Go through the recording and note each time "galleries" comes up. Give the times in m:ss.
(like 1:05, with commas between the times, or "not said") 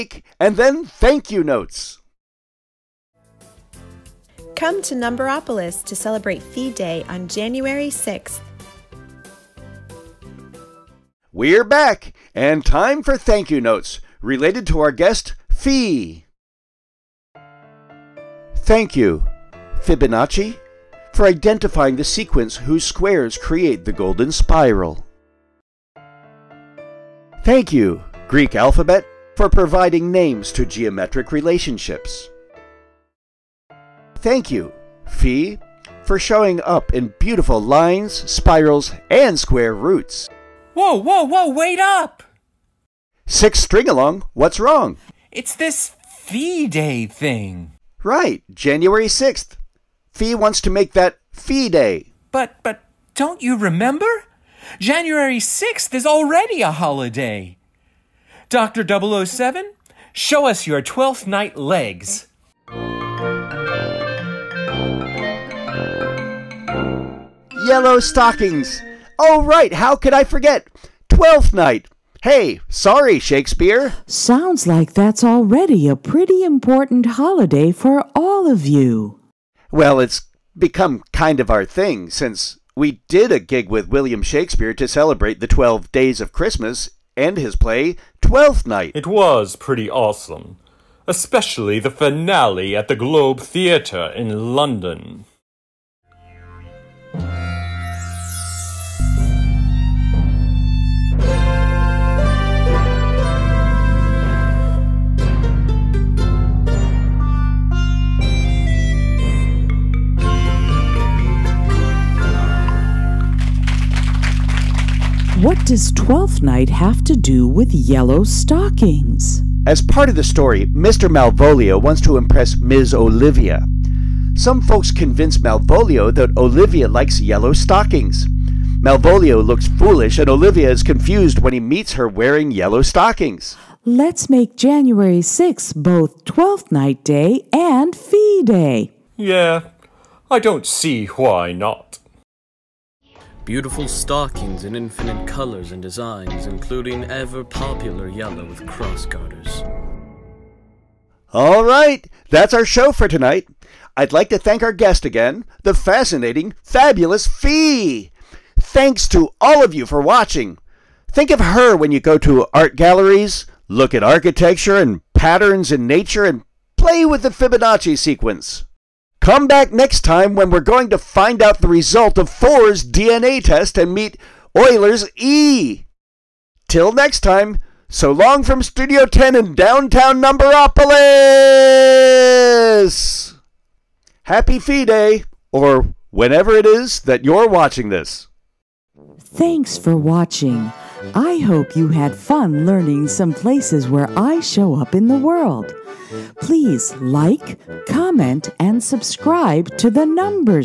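2:42.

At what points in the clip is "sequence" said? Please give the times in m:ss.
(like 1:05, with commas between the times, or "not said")
0:22, 2:47.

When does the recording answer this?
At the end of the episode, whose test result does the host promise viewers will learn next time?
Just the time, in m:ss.
2:52.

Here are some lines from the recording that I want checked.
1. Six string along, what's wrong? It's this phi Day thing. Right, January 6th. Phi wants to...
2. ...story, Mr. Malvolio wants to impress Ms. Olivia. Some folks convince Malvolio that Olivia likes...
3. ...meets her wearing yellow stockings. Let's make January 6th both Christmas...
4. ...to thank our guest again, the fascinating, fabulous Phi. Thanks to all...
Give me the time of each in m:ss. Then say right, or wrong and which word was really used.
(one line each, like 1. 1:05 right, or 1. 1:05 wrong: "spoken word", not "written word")
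1. 0:43 right
2. 2:00 right
3. 2:11 wrong: "Twelfth", not "Christmas"
4. 2:34 right.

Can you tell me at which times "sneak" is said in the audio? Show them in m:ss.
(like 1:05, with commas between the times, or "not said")
not said.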